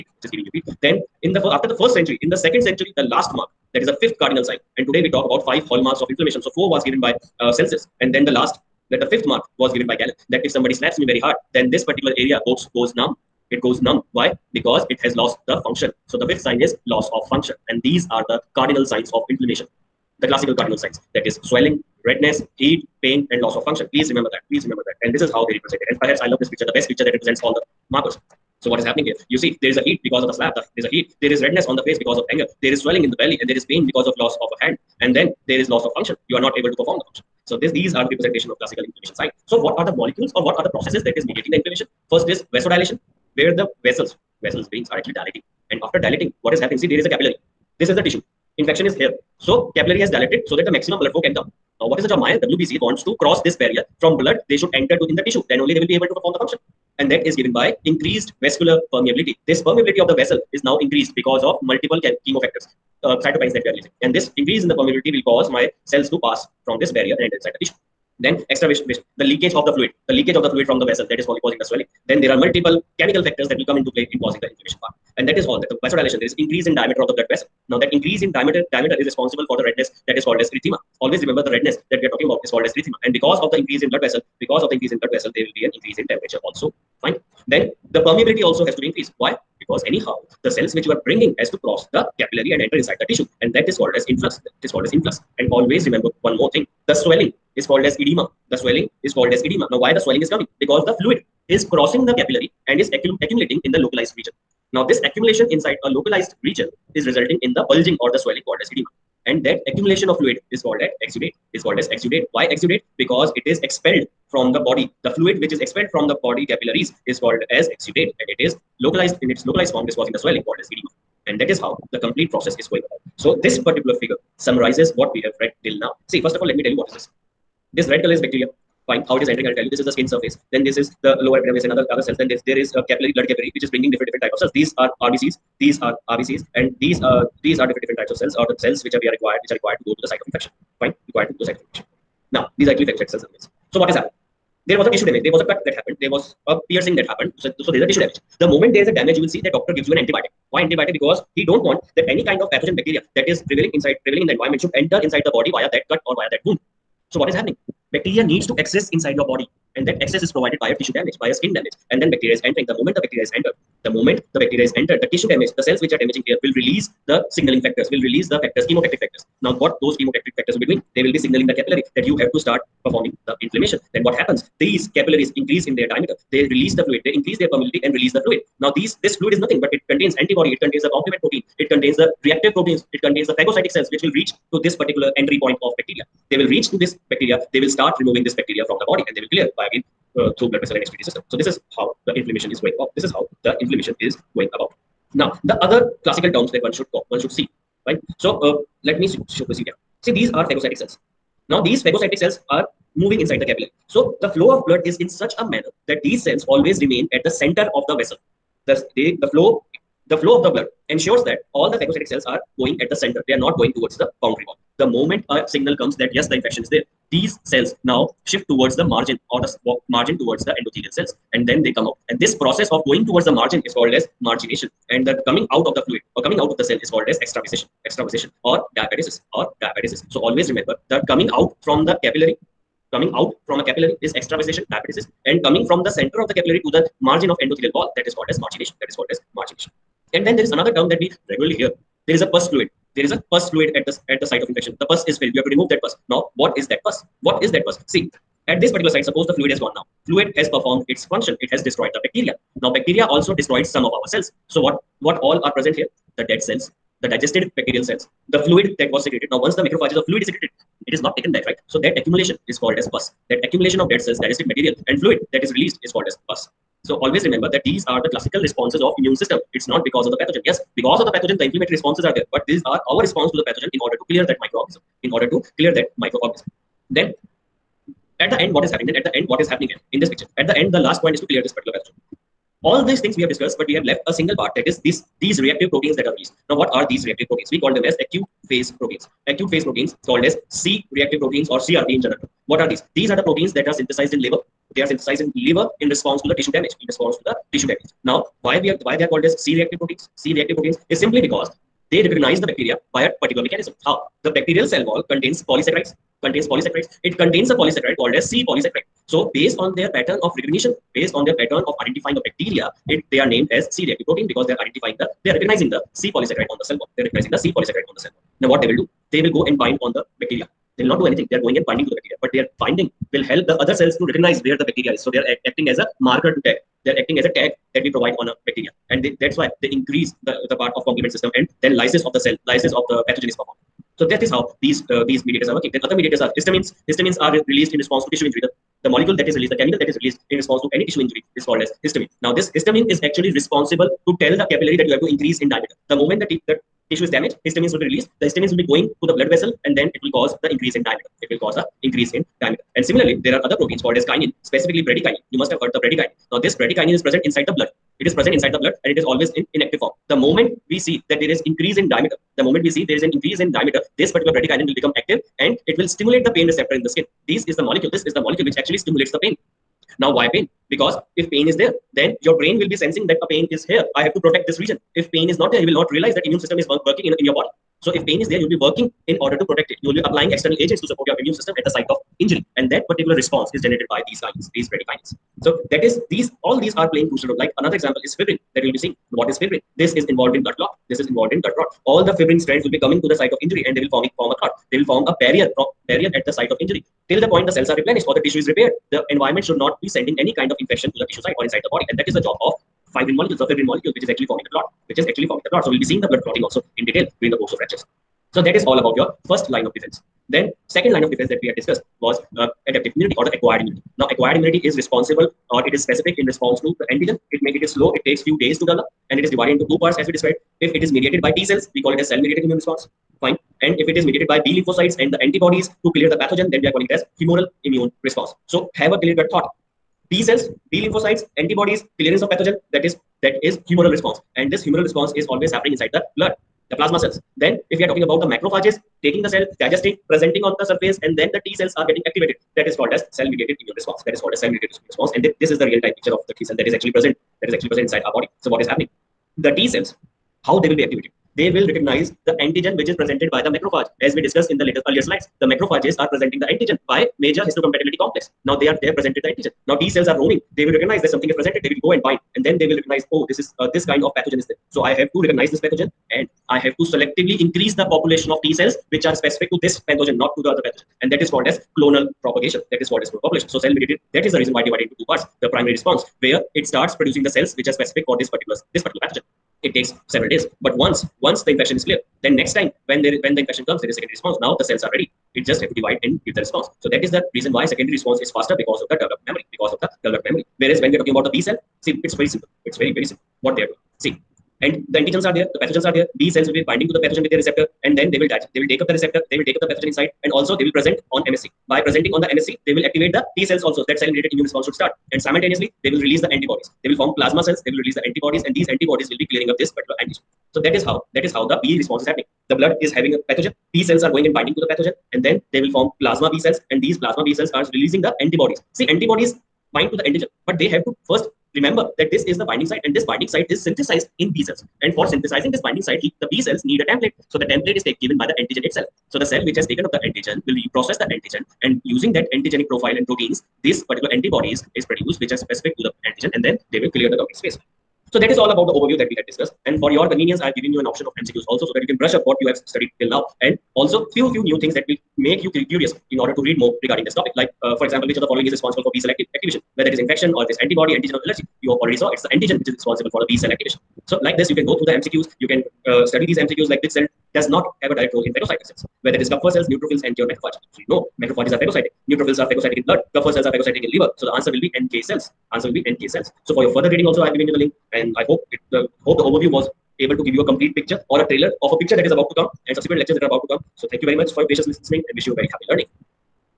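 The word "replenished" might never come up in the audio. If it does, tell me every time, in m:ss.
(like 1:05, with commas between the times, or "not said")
6:37.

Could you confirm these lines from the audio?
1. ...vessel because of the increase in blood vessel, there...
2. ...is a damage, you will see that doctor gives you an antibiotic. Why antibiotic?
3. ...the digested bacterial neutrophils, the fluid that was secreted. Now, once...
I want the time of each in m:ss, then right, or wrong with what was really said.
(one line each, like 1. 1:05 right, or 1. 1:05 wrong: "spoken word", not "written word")
1. 1:24 right
2. 2:28 right
3. 4:17 wrong: "cells", not "neutrophils".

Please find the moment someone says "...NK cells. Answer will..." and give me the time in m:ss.
9:24.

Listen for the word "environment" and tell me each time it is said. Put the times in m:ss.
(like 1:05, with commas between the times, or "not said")
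2:34, 6:39.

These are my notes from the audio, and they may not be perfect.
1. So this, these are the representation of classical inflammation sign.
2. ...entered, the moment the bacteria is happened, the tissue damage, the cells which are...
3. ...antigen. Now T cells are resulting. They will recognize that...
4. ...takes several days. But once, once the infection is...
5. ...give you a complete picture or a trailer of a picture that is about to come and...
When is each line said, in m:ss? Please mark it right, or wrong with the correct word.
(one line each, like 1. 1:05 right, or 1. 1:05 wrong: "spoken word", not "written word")
1. 0:37 right
2. 2:43 wrong: "entered", not "happened"
3. 7:39 wrong: "roaming", not "resulting"
4. 7:59 right
5. 9:30 right.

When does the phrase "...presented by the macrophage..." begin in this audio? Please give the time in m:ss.
7:33.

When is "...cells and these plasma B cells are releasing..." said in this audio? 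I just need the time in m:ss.
8:36.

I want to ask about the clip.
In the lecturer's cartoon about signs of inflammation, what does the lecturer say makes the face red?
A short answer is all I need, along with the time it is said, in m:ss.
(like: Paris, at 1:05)
Anger, at 0:31.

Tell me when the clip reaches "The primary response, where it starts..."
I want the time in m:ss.
7:55.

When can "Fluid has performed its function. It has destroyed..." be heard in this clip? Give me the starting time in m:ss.
4:10.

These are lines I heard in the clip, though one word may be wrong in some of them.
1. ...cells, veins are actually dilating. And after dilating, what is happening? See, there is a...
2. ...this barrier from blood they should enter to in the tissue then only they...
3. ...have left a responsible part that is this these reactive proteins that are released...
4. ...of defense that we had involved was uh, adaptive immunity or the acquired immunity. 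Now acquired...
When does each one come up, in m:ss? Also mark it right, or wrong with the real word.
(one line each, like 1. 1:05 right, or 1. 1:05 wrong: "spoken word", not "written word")
1. 0:44 wrong: "vessels", not "cells"
2. 0:53 right
3. 4:43 wrong: "single", not "responsible"
4. 6:51 wrong: "discussed", not "involved".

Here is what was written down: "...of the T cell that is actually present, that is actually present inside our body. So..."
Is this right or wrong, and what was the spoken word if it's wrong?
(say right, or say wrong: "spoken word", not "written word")
right.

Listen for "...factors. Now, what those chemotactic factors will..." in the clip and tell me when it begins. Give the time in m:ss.
2:49.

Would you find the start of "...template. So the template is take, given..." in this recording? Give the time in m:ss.
8:46.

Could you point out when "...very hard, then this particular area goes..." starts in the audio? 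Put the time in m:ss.
0:11.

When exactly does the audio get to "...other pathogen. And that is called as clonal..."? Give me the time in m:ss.
7:50.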